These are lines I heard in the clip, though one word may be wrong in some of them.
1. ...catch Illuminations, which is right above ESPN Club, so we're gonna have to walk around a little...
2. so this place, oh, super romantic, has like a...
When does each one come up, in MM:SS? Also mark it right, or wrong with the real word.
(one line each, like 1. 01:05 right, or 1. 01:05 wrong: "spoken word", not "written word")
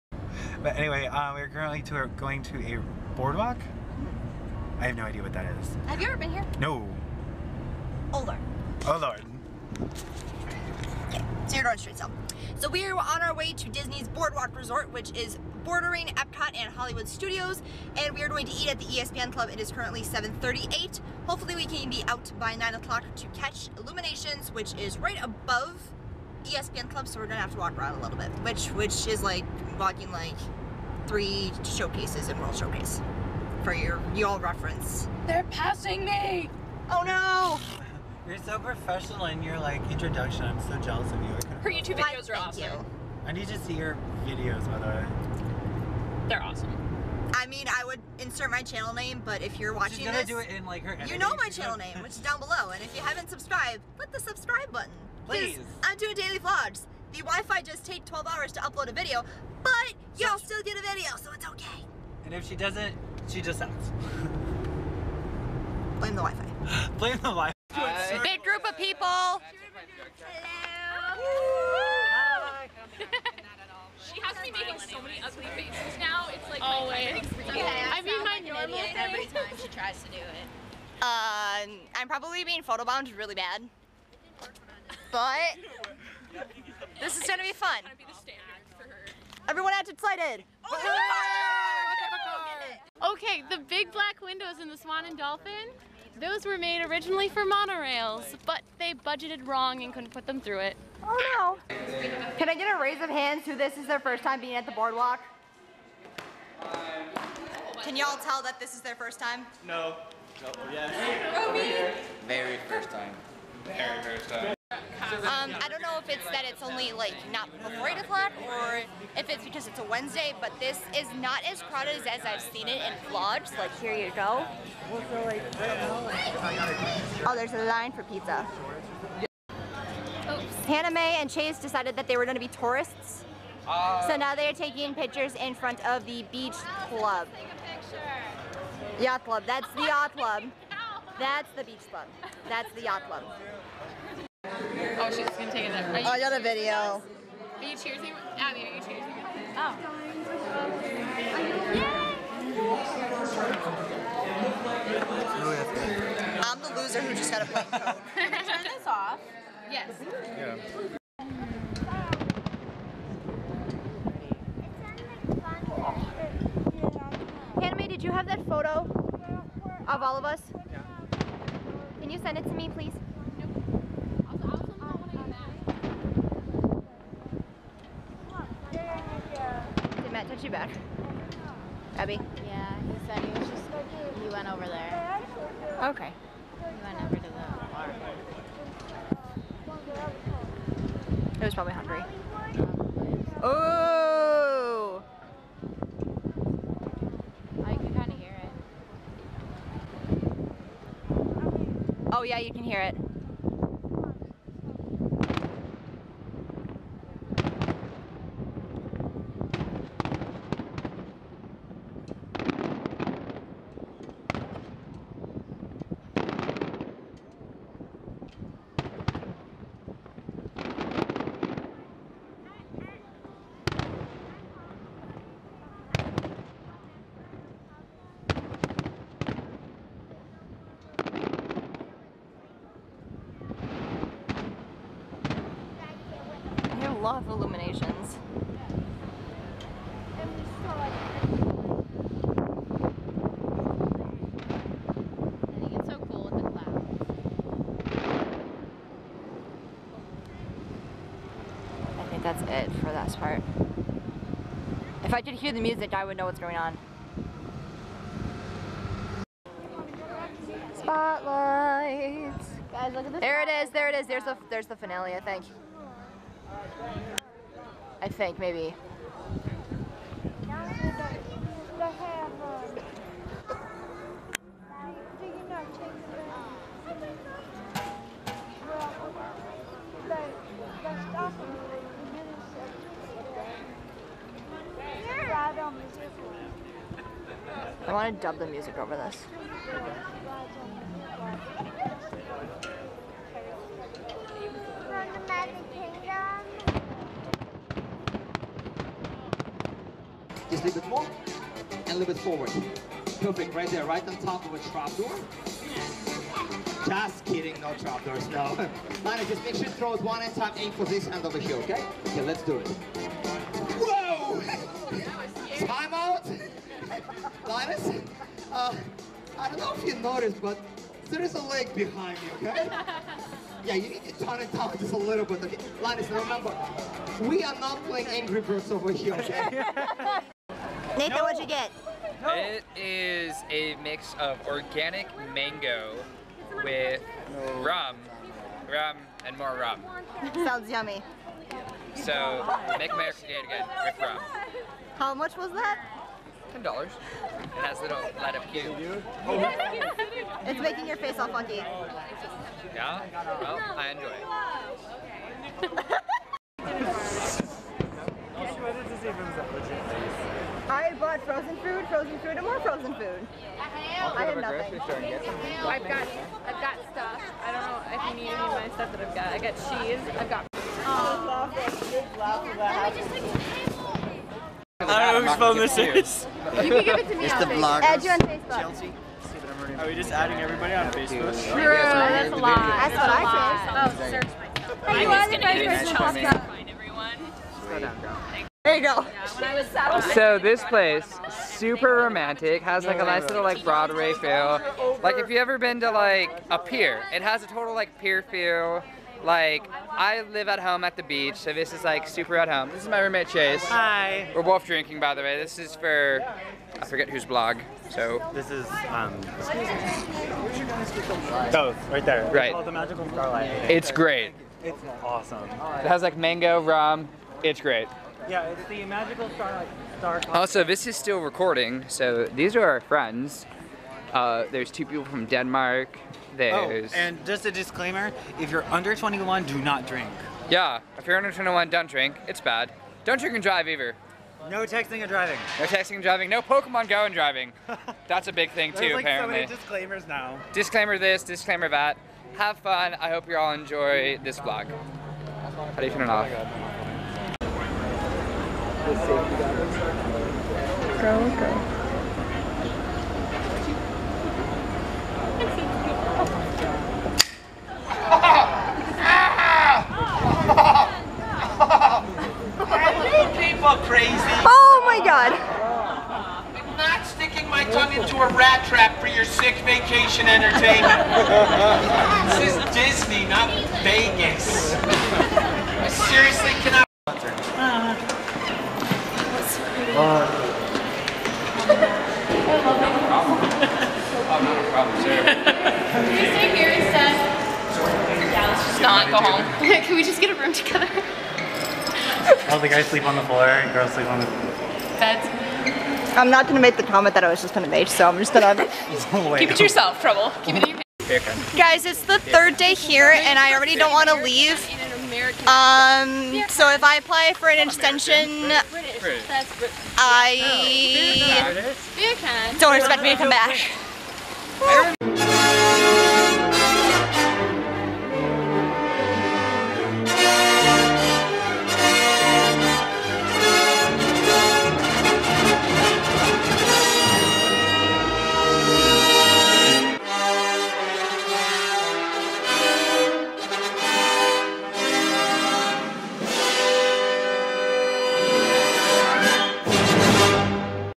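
1. 00:23 right
2. 06:30 right.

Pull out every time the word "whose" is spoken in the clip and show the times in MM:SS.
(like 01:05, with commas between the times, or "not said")
06:15, 06:47.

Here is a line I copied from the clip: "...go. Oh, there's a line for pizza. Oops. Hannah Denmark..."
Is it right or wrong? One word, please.
wrong.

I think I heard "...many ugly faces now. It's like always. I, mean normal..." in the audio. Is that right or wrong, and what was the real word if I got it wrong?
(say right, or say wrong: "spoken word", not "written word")
right.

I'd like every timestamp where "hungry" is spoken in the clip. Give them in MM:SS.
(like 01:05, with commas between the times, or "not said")
03:11.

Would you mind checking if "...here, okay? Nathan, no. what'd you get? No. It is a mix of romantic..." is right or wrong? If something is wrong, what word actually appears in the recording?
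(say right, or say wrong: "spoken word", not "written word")
wrong: "organic", not "romantic".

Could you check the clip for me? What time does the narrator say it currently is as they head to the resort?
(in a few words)
7:38.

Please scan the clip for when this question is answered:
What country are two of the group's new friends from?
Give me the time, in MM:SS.
07:05.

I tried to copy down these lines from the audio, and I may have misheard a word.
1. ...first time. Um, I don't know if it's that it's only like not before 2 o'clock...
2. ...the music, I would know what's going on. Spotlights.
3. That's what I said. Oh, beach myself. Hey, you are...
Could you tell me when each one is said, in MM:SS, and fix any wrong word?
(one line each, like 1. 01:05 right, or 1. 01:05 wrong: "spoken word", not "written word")
1. 01:54 wrong: "8", not "2"
2. 04:15 right
3. 06:22 wrong: "search", not "beach".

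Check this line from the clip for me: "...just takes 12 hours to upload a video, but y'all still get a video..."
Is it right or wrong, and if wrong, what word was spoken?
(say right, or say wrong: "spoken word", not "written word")
right.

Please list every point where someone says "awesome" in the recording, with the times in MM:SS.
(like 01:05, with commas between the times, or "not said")
00:42, 00:46, 06:55.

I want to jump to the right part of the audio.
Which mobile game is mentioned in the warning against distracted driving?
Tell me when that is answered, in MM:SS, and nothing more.
07:16.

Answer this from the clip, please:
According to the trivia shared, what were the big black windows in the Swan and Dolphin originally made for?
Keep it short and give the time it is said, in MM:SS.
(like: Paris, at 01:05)
Monorails, at 01:37.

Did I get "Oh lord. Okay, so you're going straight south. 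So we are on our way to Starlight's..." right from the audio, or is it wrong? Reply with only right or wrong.
wrong.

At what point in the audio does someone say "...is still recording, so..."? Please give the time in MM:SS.
07:00.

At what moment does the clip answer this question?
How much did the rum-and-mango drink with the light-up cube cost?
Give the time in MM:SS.
05:46.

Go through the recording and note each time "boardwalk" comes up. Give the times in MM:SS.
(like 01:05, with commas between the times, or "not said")
00:03, 00:14, 01:44.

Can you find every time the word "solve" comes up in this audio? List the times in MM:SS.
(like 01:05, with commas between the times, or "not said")
not said.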